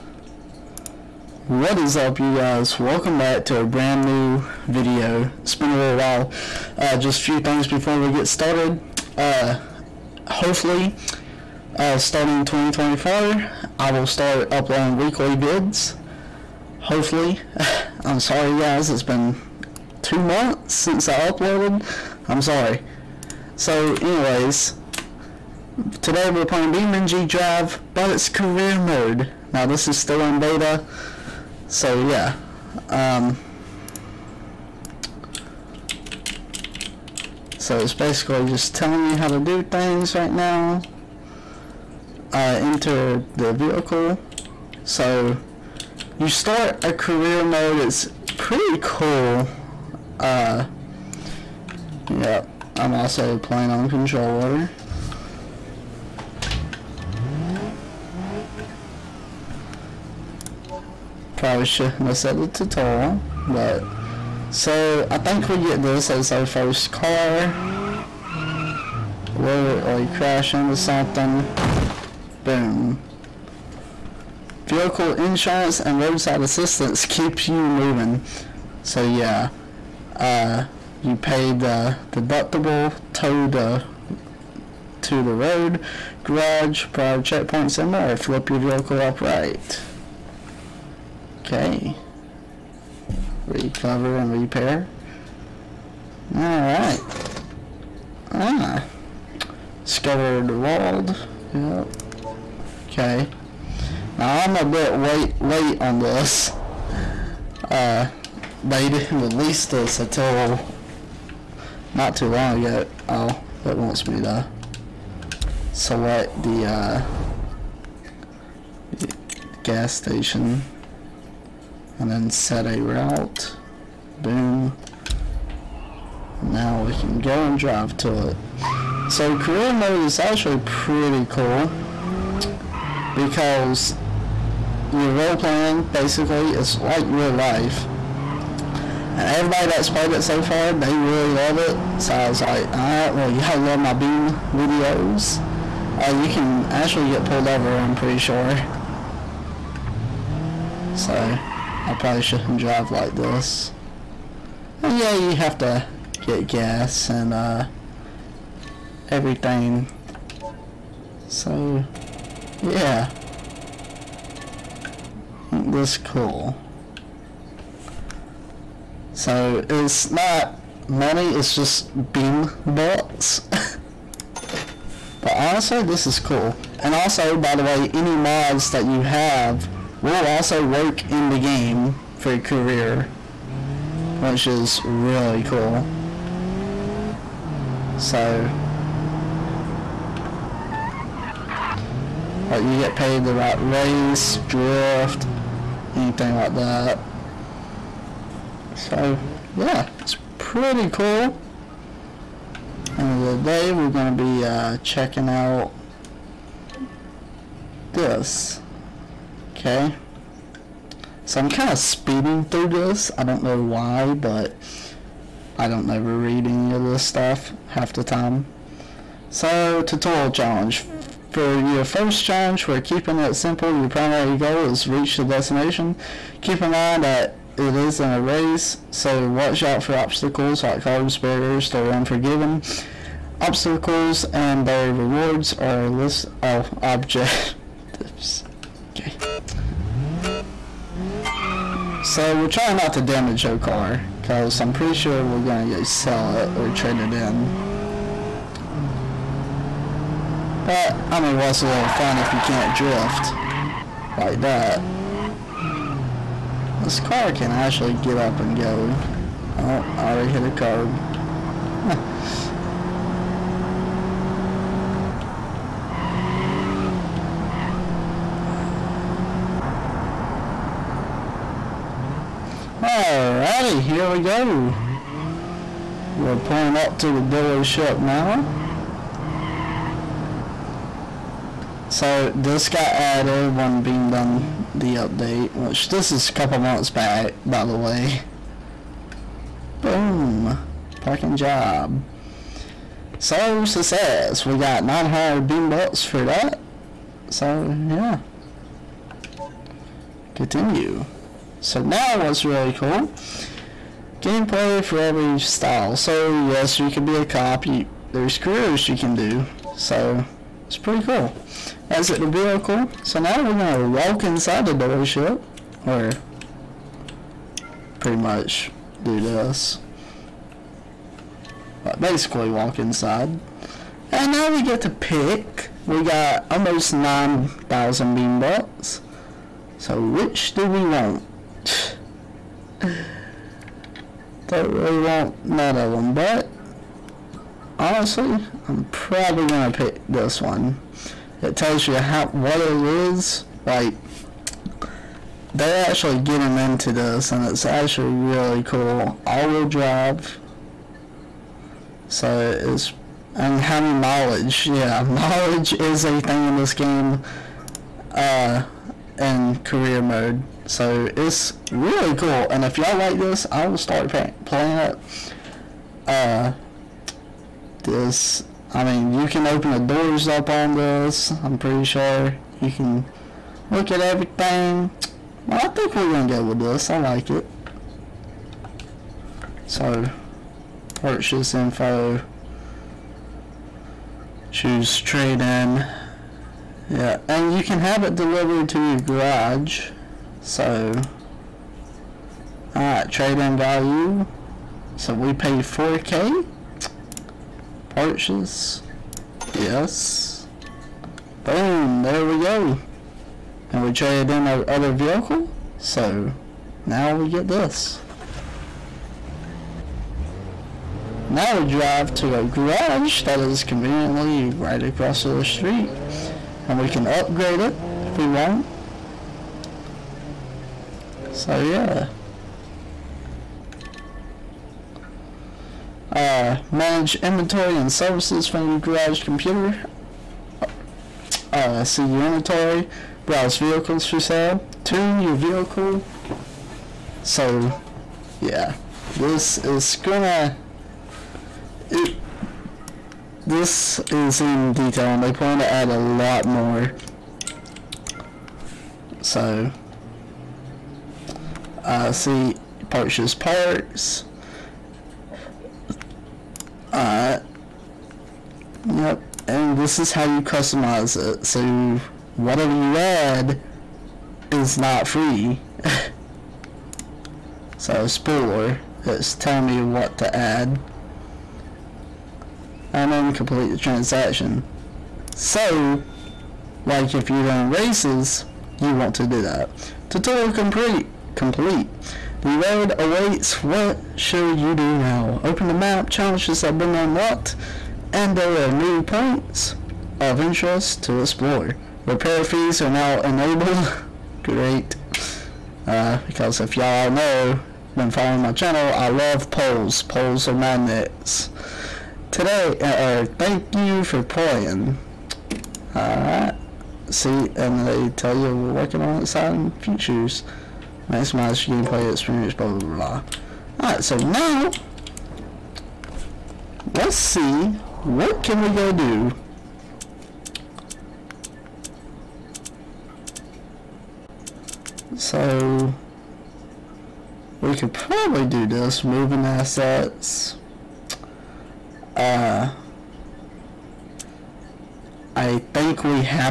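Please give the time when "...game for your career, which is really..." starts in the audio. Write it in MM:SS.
03:01.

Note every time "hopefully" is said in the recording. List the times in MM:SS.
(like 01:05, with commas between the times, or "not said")
00:10, 00:16.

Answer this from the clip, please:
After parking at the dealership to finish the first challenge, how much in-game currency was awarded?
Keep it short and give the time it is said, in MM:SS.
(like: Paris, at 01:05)
900 beam bucks, at 04:54.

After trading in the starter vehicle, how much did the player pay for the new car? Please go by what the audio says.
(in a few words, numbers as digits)
4k.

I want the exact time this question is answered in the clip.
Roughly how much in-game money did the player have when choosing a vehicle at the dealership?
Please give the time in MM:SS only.
05:26.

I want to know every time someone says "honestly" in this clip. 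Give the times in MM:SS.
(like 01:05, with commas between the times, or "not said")
02:55, 05:37.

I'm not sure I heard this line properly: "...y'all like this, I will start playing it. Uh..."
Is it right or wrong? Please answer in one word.
right.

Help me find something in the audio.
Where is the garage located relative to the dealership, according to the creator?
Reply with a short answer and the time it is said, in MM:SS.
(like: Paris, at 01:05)
Right across the street, at 06:54.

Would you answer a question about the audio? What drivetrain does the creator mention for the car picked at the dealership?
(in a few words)
All-wheel drive.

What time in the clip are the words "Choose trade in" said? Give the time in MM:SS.
06:24.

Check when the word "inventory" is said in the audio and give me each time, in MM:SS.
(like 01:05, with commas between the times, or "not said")
07:07, 07:12.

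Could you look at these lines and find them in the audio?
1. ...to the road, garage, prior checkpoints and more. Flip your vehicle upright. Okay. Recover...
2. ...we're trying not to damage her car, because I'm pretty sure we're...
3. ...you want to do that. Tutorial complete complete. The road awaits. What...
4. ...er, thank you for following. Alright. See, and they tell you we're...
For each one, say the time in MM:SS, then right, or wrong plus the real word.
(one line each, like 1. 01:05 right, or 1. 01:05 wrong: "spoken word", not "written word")
1. 01:25 right
2. 04:02 right
3. 07:58 right
4. 08:23 wrong: "playing", not "following".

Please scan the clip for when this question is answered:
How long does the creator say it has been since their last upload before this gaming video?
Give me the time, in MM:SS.
00:20.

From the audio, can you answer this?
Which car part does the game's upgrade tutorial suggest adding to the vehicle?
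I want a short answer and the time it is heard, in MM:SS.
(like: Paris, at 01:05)
Spoiler, at 07:48.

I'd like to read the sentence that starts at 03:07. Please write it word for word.
So, like you get paid the right race, drift, anything like that.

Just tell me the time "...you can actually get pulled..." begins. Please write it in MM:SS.
02:26.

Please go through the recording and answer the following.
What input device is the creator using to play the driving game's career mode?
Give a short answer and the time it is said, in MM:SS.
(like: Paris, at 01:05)
Controller, at 00:53.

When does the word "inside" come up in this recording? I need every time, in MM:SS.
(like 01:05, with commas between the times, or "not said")
05:14, 05:22.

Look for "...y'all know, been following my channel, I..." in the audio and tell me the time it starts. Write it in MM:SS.
08:16.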